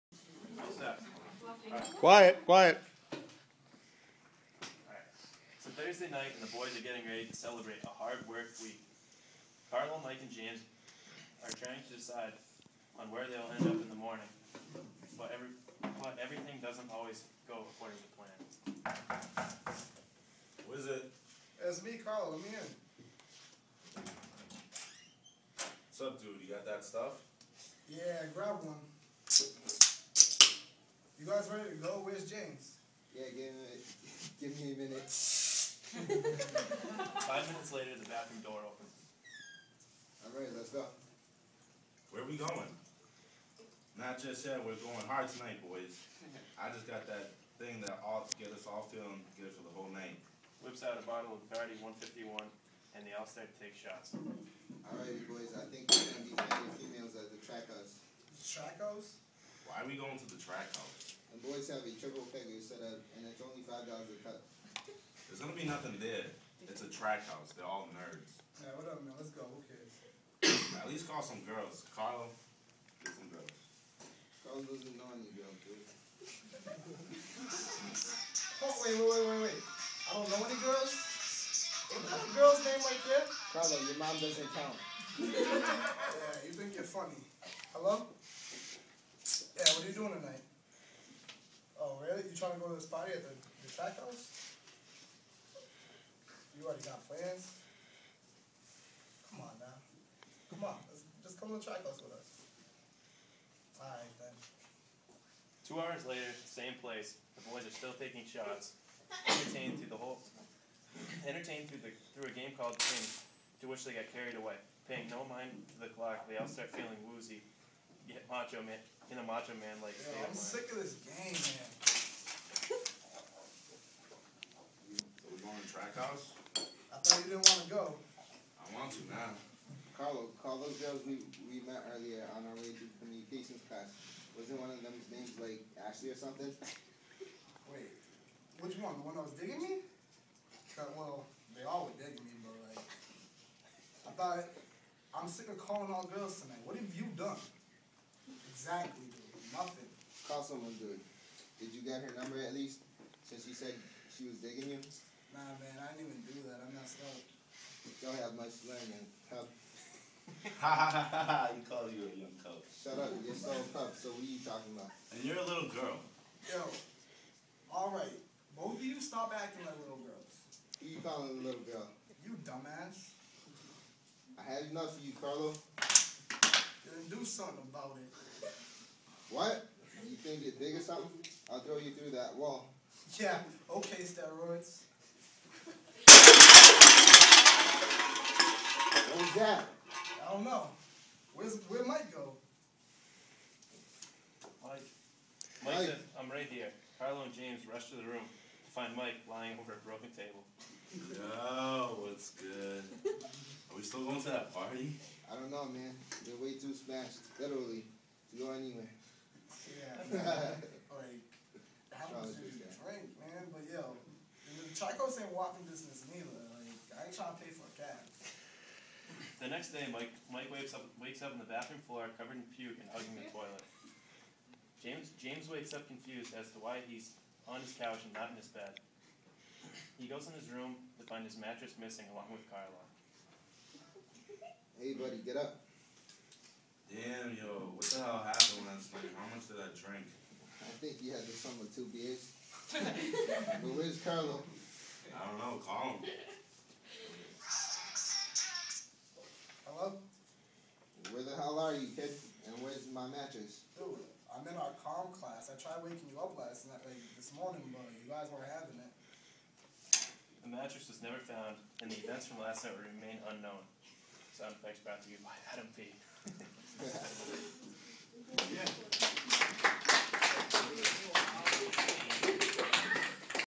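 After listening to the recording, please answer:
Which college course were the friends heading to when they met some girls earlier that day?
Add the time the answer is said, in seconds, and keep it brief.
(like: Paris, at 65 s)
Communications, at 132 s.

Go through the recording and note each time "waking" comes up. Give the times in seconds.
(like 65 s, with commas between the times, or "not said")
255 s.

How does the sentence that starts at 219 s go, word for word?
The next day, Mike Mike wakes up wakes up on the bathroom floor, covered in puke and hugging the toilet.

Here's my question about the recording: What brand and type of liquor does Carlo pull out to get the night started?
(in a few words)
Bacardi 151.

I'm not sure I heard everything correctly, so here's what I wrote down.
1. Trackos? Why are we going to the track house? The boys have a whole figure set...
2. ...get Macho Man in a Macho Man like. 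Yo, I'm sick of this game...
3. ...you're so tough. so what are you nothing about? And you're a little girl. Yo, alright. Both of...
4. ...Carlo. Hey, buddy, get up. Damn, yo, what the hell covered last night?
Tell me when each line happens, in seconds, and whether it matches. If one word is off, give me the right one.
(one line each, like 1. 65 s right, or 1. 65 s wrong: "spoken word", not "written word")
1. 58 s wrong: "triple", not "whole"
2. 118 s right
3. 163 s wrong: "talking", not "nothing"
4. 232 s wrong: "happened", not "covered".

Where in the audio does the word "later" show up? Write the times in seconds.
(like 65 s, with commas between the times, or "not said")
37 s, 106 s.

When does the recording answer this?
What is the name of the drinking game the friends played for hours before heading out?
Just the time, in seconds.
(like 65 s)
112 s.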